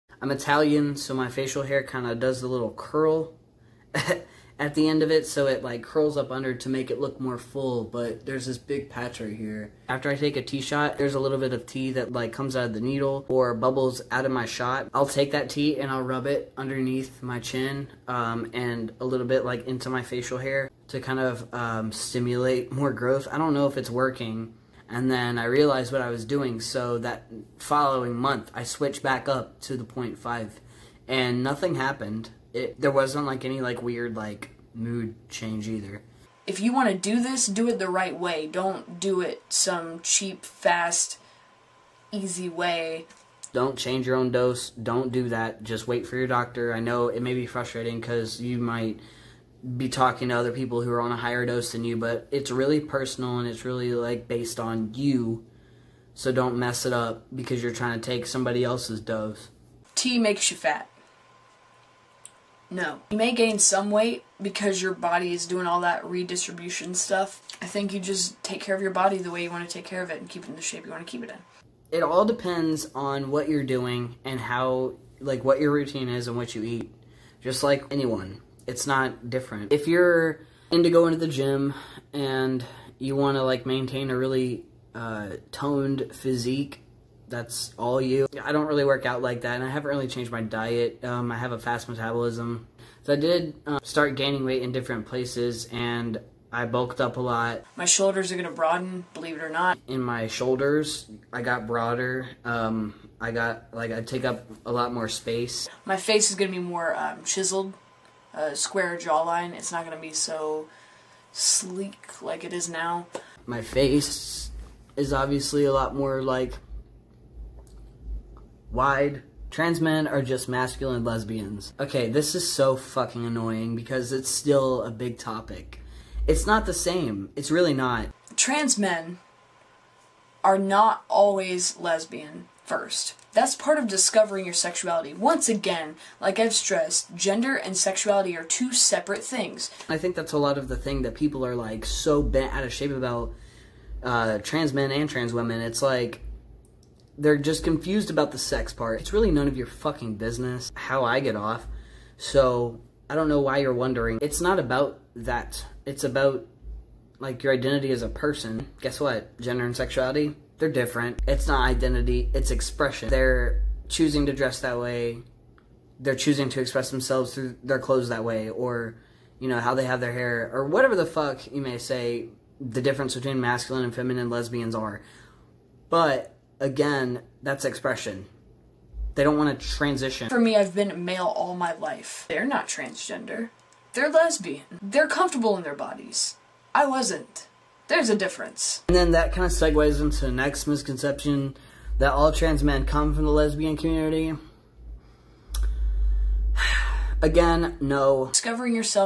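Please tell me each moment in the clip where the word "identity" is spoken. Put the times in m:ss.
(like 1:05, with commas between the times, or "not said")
2:37, 2:41.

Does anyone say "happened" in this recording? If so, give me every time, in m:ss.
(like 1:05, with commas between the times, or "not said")
0:31.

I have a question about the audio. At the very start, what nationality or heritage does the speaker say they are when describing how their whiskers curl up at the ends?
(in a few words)
Italian.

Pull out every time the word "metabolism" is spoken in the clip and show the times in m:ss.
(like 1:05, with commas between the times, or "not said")
1:31.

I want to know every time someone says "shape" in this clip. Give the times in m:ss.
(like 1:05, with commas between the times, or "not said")
1:10, 2:22.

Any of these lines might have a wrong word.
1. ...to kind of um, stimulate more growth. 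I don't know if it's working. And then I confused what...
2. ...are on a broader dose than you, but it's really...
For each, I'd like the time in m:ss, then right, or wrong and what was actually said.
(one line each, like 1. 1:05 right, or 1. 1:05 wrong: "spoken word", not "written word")
1. 0:20 wrong: "realized", not "confused"
2. 0:50 wrong: "higher", not "broader".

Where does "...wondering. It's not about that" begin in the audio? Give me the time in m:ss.
2:33.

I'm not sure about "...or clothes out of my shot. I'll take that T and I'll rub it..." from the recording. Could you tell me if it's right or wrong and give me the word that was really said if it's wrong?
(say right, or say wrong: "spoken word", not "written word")
wrong: "bubbles", not "clothes".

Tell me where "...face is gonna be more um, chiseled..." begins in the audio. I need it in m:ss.
1:45.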